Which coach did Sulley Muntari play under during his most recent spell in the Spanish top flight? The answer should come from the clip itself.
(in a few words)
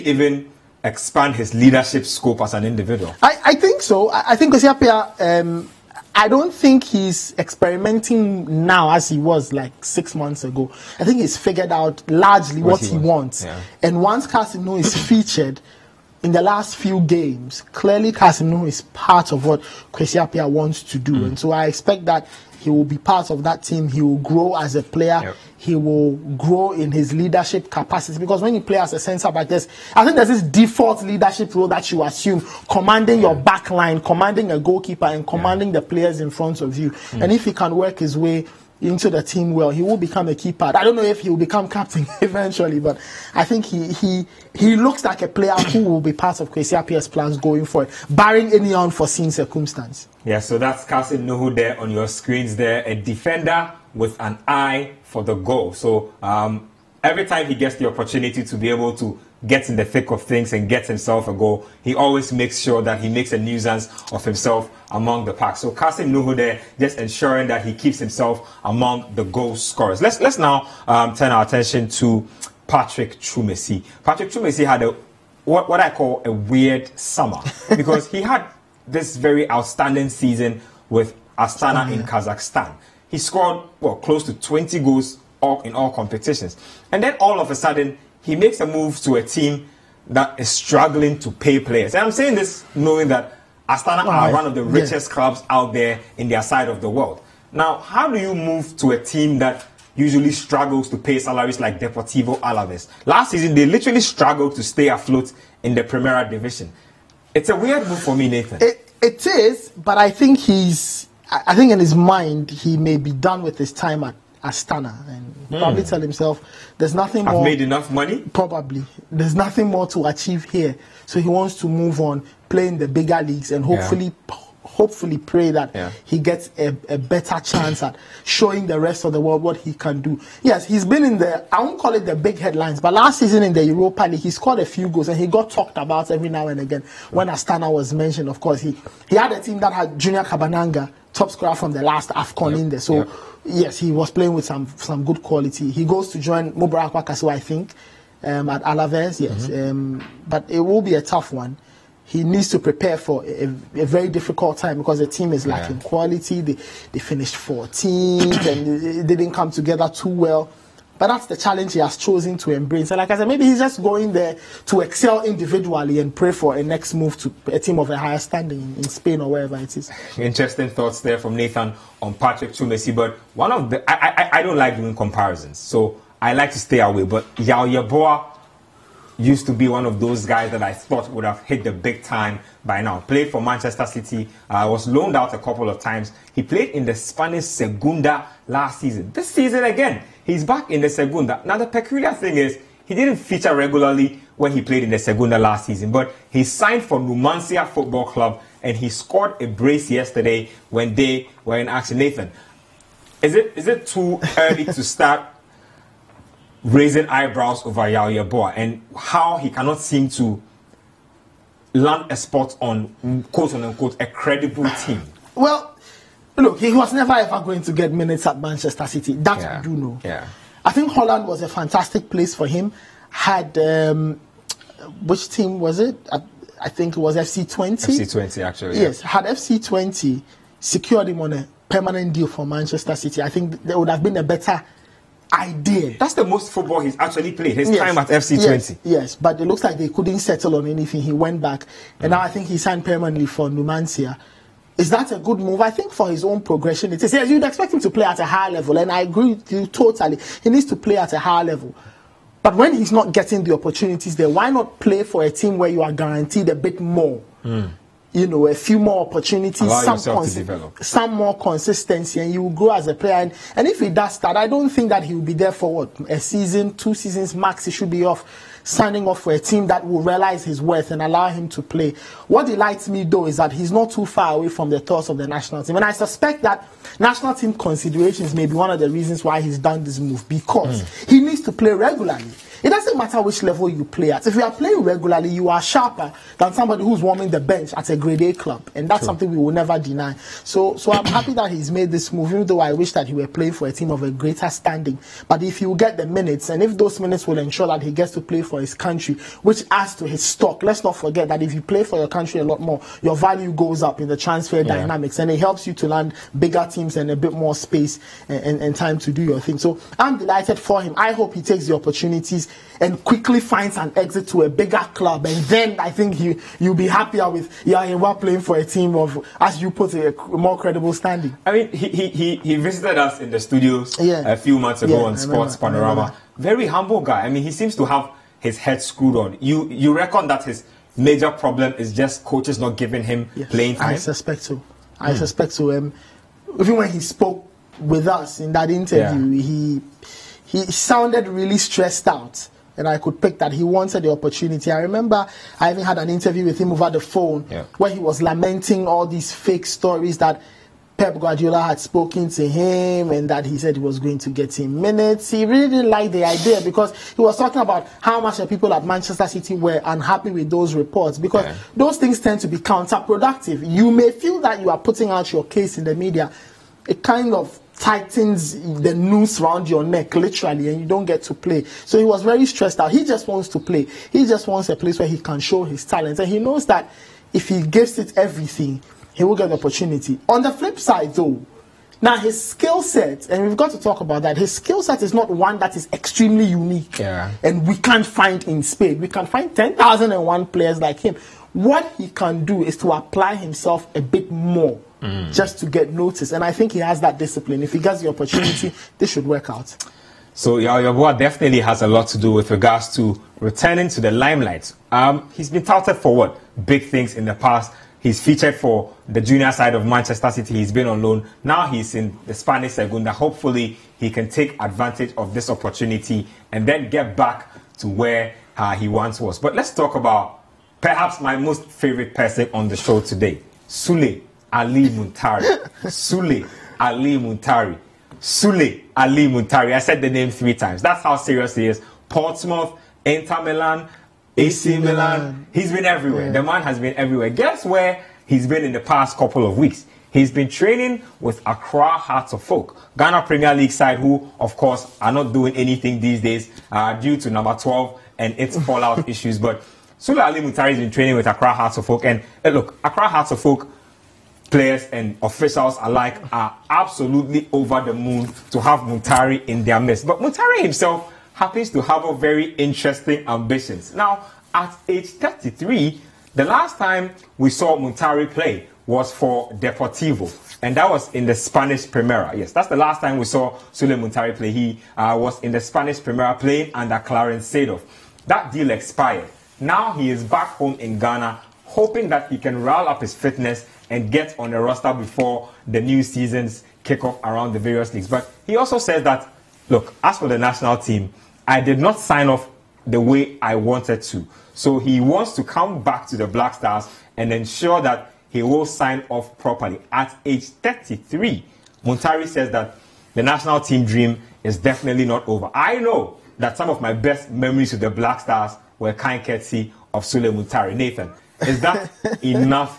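Clarence Seedorf.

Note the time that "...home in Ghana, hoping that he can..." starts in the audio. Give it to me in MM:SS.
08:00.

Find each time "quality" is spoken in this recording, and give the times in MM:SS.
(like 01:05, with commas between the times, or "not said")
02:25, 02:35.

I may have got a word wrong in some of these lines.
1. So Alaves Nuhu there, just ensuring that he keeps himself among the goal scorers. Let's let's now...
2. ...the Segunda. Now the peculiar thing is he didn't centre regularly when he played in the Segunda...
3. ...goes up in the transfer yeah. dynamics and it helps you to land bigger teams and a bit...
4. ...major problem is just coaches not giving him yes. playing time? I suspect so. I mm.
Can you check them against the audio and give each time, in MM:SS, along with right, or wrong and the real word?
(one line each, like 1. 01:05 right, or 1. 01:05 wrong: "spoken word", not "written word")
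1. 01:05 wrong: "Kasim", not "Alaves"
2. 03:10 wrong: "feature", not "centre"
3. 05:03 right
4. 05:30 right.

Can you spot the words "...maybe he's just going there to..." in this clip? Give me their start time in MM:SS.
02:43.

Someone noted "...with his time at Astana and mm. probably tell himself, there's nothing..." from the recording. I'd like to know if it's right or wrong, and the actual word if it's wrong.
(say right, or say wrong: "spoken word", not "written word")
right.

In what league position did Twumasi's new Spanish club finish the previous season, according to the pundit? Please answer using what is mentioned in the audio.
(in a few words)
14th.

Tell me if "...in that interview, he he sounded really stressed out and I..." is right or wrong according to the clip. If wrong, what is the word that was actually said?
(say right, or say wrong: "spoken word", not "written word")
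right.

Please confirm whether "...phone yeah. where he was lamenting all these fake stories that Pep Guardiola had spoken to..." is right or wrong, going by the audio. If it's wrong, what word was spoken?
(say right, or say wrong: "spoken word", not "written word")
right.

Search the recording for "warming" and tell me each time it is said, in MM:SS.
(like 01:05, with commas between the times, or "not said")
04:47.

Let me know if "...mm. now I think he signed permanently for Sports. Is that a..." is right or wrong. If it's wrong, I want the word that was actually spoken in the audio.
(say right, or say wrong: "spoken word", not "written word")
wrong: "Numancia", not "Sports".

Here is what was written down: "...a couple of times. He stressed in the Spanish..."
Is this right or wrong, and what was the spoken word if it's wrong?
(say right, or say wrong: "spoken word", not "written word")
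wrong: "played", not "stressed".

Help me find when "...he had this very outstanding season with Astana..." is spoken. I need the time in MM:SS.
01:18.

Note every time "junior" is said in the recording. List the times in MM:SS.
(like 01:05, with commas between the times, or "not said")
02:19, 06:49.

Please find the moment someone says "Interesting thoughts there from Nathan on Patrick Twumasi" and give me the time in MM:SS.
02:50.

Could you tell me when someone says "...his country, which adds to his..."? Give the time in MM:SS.
04:58.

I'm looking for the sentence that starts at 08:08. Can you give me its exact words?
But he also says that, look, as for the national team, I did not sign off the way I wanted to.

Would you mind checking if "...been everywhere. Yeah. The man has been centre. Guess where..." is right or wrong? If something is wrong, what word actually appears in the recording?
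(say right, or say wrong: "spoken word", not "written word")
wrong: "everywhere", not "centre".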